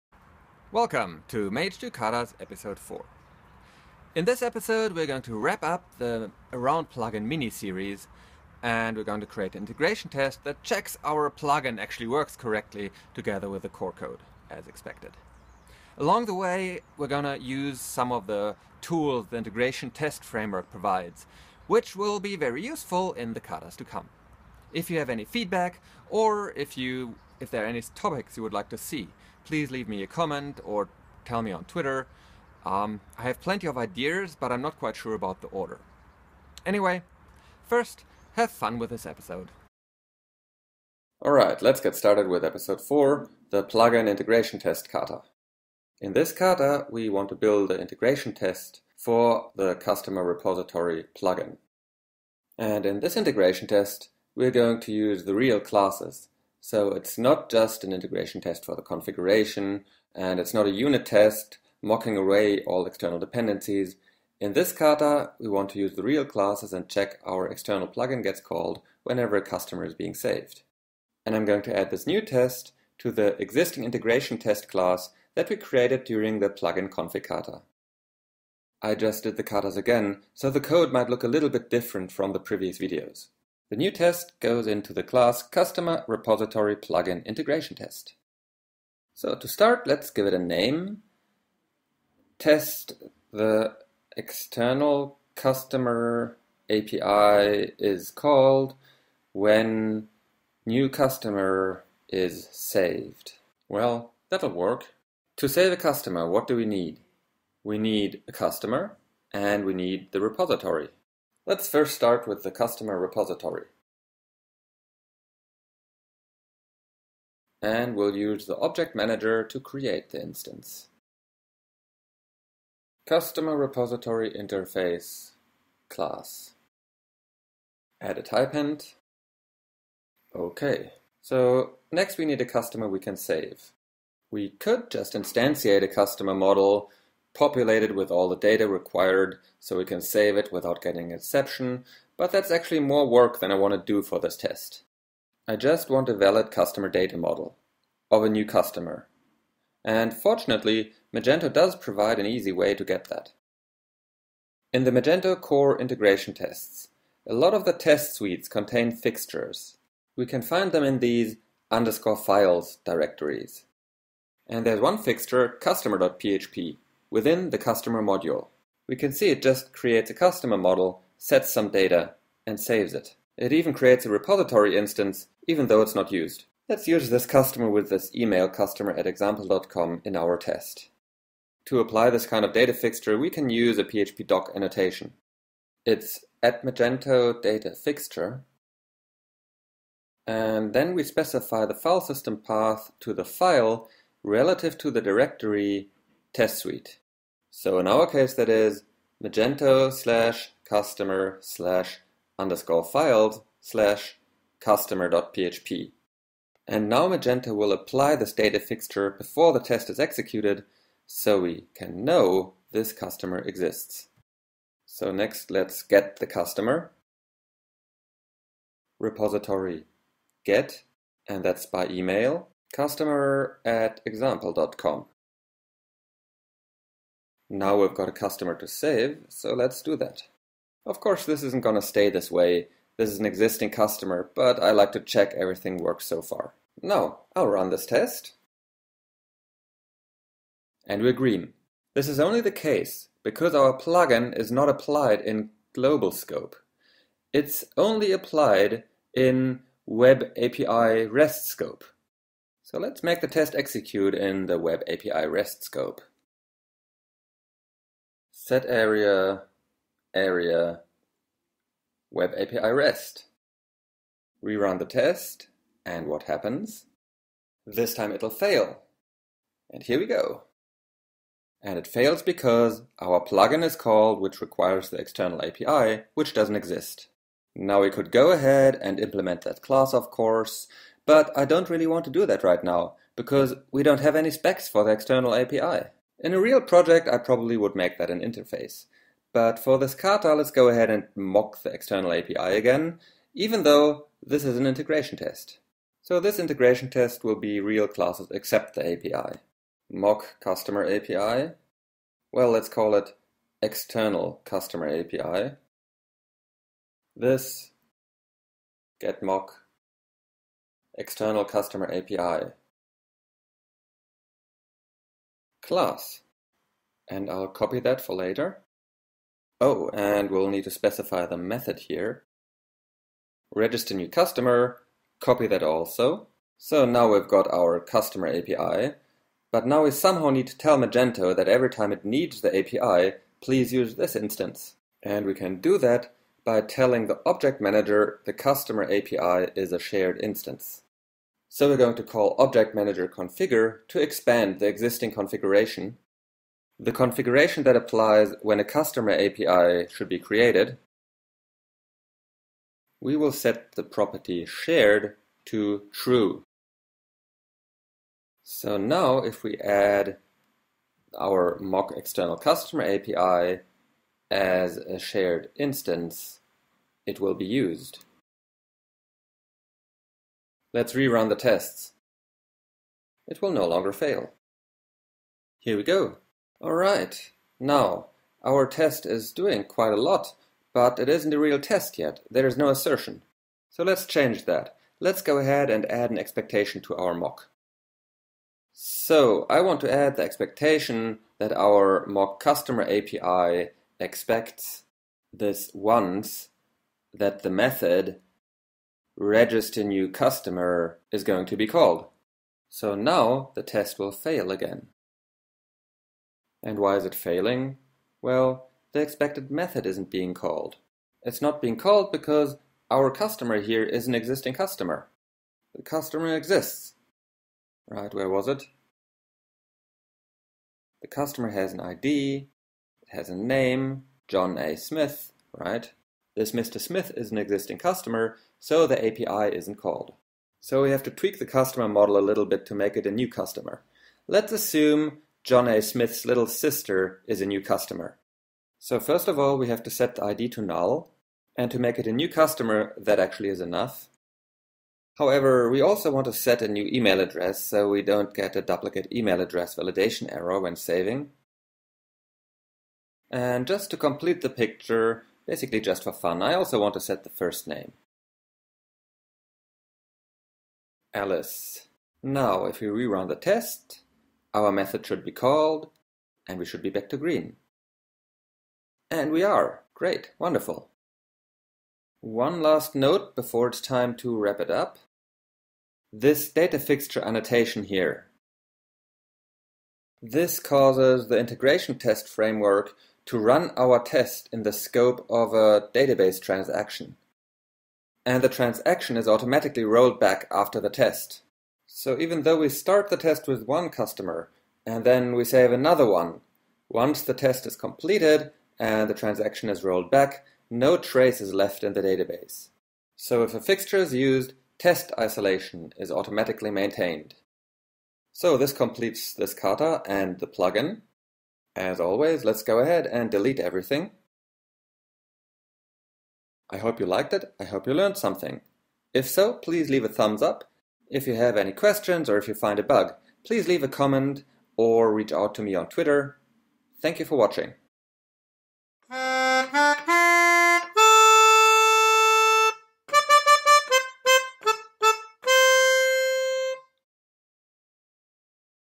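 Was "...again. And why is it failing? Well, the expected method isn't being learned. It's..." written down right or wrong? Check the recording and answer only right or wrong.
wrong.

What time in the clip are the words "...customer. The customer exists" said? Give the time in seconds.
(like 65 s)
414 s.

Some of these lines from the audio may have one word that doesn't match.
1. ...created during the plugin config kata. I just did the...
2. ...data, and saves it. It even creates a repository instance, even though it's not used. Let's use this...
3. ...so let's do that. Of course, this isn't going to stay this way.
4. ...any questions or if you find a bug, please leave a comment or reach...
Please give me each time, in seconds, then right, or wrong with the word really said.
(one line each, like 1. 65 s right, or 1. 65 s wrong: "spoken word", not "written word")
1. 75 s right
2. 171 s right
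3. 229 s right
4. 521 s right.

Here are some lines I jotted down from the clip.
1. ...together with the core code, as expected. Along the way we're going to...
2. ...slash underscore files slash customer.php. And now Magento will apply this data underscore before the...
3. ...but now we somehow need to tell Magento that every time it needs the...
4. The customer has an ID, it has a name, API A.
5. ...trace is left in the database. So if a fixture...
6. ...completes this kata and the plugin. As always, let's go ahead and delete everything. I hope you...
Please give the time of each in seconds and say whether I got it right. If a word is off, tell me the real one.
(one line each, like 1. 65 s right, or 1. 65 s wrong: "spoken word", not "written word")
1. 13 s right
2. 201 s wrong: "fixture", not "underscore"
3. 329 s right
4. 421 s wrong: "John", not "API"
5. 500 s right
6. 508 s right.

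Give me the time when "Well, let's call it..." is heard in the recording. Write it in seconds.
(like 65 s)
302 s.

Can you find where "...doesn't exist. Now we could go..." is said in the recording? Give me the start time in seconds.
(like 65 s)
276 s.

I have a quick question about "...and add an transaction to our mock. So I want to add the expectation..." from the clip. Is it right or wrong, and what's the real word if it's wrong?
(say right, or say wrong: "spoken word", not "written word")
wrong: "expectation", not "transaction".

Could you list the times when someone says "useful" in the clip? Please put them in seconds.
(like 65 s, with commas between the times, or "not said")
22 s.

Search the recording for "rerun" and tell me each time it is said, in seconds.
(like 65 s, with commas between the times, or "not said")
264 s, 370 s, 462 s.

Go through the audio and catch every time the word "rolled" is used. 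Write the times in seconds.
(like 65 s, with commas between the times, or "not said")
489 s, 499 s.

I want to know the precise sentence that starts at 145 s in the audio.
I just want a valid customer data model of a new customer.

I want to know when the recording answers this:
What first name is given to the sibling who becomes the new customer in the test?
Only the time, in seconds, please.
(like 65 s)
461 s.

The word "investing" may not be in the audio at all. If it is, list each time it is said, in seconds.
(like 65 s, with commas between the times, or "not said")
not said.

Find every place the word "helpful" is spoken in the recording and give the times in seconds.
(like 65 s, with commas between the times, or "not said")
not said.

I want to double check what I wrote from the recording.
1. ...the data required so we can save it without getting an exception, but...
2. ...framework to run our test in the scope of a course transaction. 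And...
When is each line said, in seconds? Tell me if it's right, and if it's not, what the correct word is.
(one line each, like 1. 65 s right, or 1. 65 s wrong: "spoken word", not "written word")
1. 138 s right
2. 482 s wrong: "database", not "course".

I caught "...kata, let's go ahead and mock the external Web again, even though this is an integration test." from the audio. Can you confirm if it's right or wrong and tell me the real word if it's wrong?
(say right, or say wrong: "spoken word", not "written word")
wrong: "API", not "Web".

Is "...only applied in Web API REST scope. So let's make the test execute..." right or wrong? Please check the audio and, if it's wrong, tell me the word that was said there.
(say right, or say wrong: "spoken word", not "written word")
right.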